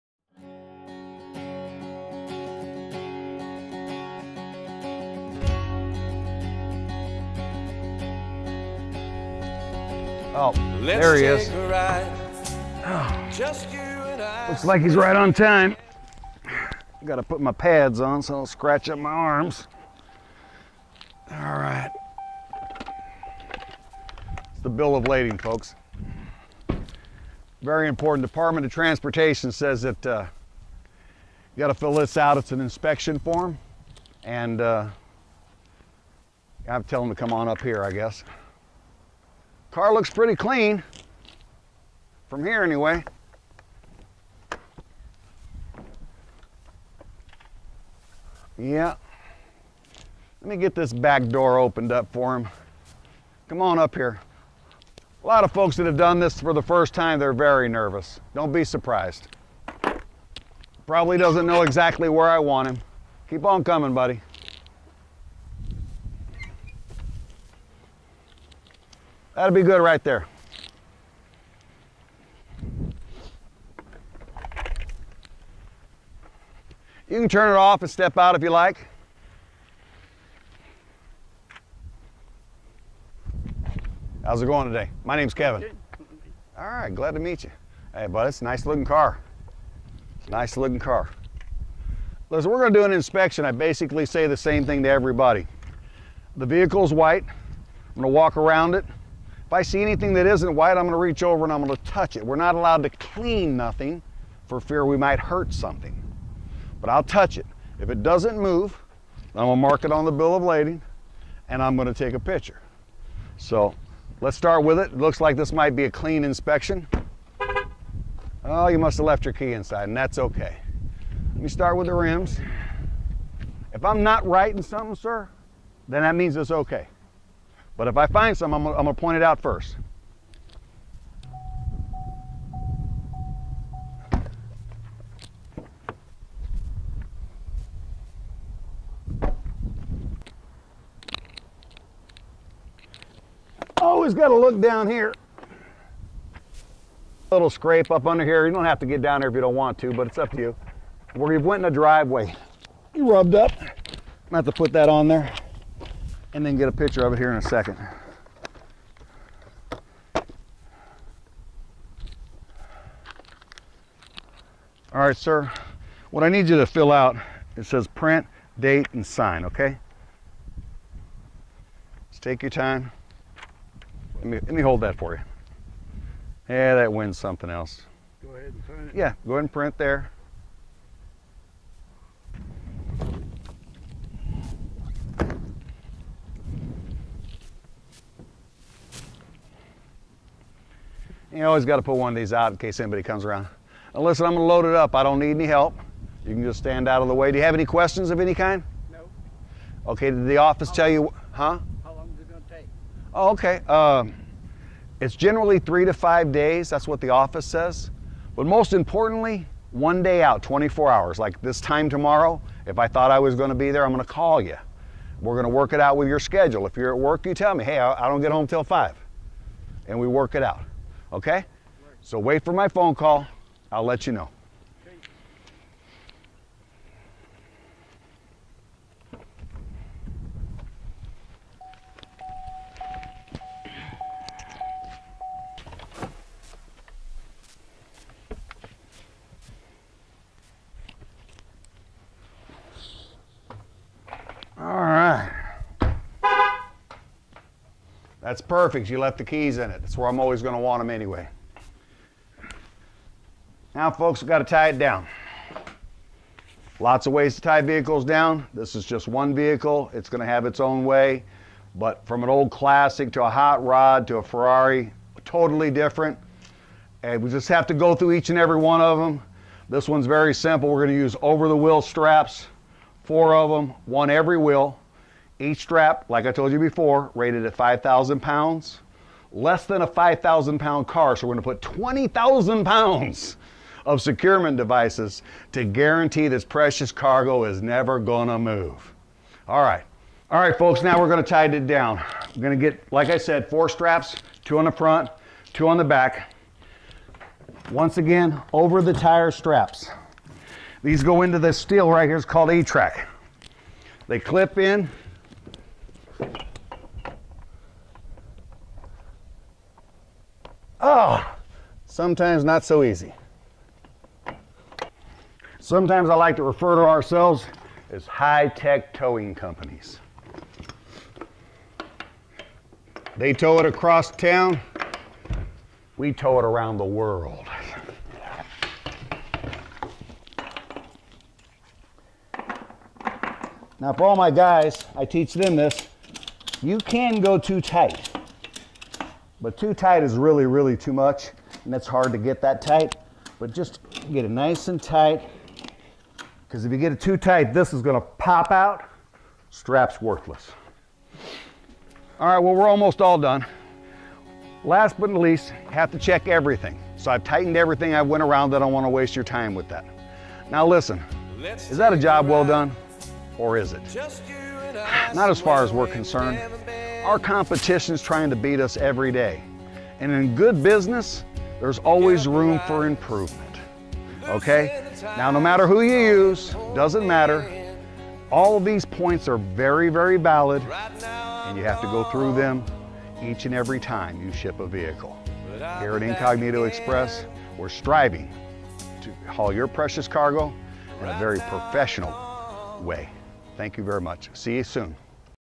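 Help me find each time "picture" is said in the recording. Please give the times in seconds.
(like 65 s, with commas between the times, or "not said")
112 s, 156 s.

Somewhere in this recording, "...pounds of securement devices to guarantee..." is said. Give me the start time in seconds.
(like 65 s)
282 s.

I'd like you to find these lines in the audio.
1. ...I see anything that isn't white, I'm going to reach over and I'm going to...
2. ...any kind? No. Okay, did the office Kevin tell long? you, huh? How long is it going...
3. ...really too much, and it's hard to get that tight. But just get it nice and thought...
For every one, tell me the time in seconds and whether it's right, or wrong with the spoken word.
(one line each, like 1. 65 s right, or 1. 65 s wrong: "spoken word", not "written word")
1. 99 s right
2. 198 s wrong: "How", not "Kevin"
3. 340 s wrong: "tight", not "thought".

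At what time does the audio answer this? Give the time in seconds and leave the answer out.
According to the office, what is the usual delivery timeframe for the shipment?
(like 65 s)
205 s.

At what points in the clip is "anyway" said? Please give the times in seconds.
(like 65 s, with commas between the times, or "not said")
42 s, 250 s.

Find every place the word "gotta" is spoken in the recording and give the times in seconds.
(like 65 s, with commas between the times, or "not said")
17 s, 31 s, 144 s.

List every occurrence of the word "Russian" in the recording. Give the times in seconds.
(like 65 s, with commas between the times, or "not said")
not said.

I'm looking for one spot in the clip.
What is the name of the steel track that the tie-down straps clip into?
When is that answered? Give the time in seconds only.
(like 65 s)
302 s.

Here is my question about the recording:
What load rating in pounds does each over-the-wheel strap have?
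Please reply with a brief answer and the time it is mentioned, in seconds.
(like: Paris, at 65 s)
5,000 pounds, at 277 s.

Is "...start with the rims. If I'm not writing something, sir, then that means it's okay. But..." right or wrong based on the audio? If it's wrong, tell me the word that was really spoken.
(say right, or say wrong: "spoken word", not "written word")
right.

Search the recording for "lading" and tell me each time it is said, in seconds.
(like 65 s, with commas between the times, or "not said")
25 s, 110 s.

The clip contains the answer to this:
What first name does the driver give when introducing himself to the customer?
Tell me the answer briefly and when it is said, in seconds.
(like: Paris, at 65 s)
Kevin, at 85 s.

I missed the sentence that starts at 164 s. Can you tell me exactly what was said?
All right, sir, what I need you to fill out, it says print, date, and sign, okay?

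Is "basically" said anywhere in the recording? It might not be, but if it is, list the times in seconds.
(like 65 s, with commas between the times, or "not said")
93 s.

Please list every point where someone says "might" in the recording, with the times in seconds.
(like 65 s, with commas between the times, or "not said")
104 s, 115 s.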